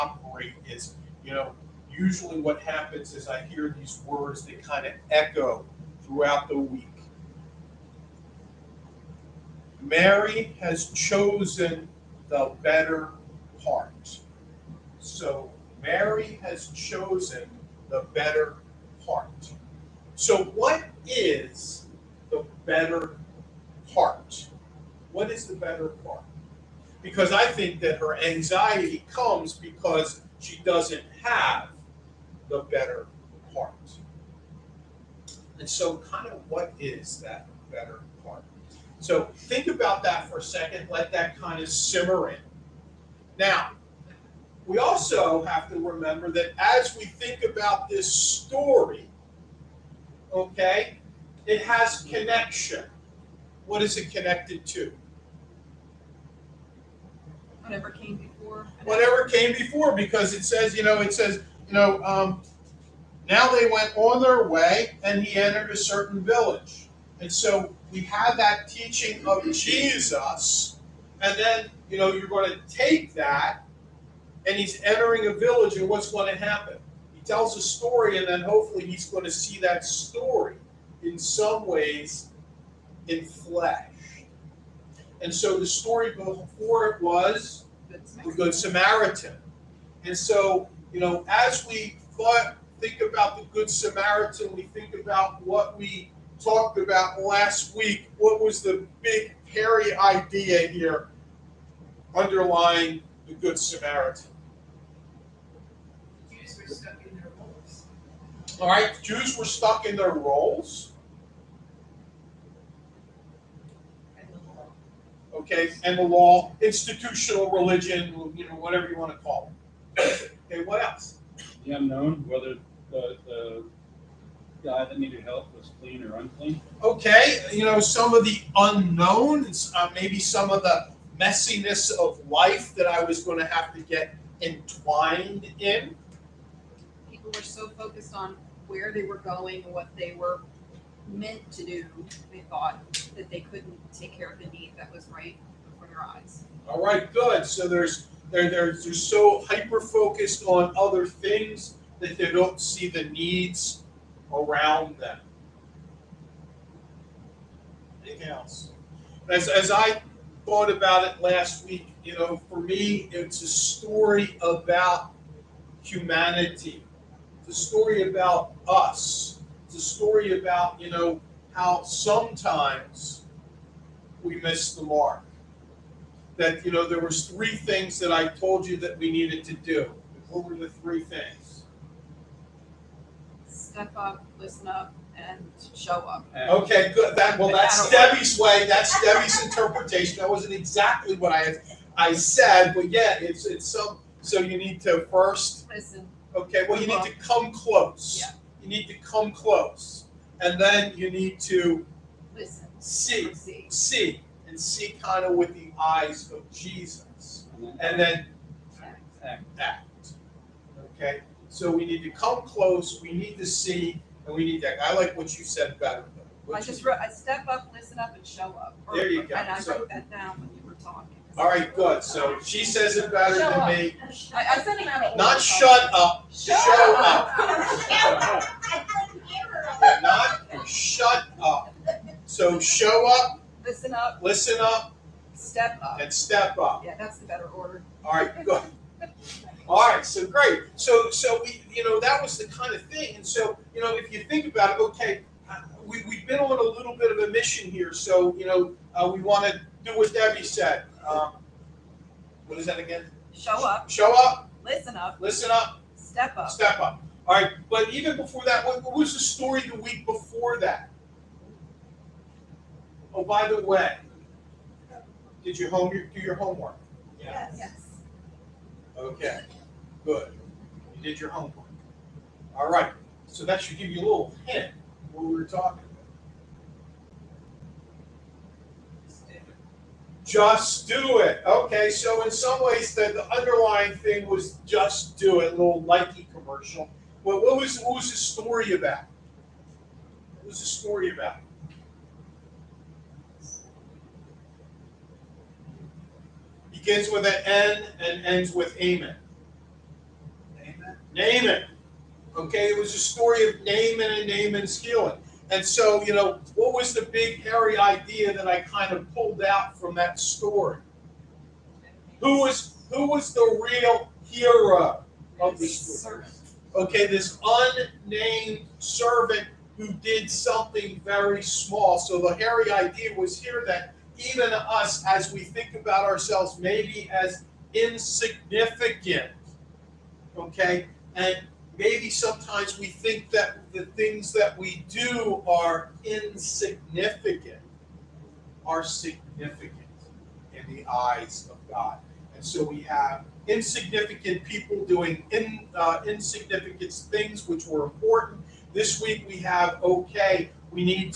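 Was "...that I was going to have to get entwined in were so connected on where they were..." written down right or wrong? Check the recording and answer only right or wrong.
wrong.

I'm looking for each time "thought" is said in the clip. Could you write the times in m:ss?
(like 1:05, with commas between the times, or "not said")
1:32, 2:22, 2:40.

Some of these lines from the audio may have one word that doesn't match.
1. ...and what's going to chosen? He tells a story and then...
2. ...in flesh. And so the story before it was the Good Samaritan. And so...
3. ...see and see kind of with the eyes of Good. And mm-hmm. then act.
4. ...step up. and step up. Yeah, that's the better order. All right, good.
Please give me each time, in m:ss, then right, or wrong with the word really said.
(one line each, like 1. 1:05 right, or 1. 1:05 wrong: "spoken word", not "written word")
1. 1:15 wrong: "happen", not "chosen"
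2. 1:23 right
3. 3:23 wrong: "Jesus", not "Good"
4. 3:55 right.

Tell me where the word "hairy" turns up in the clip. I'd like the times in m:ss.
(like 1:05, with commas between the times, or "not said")
1:39, 5:07, 5:22.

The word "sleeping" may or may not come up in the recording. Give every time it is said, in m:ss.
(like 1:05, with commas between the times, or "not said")
not said.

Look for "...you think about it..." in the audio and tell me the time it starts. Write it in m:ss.
4:04.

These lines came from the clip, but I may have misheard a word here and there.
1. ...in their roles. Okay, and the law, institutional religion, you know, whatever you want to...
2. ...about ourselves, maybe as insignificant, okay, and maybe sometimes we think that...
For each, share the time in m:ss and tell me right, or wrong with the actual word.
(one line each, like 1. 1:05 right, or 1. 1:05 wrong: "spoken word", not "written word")
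1. 1:49 right
2. 5:25 right.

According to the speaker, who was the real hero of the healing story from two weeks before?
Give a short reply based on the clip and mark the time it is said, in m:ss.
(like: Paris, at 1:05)
unnamed servant, at 5:17.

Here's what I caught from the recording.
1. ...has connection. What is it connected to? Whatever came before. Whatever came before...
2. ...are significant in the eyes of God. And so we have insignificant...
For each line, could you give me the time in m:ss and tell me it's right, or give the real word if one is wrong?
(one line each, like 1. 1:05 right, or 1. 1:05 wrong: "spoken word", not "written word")
1. 0:51 right
2. 5:38 right.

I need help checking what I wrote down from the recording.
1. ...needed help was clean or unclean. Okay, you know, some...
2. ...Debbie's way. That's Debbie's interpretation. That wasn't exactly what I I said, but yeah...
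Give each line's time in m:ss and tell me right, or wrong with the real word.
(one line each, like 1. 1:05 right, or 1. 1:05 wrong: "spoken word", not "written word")
1. 2:04 right
2. 3:07 right.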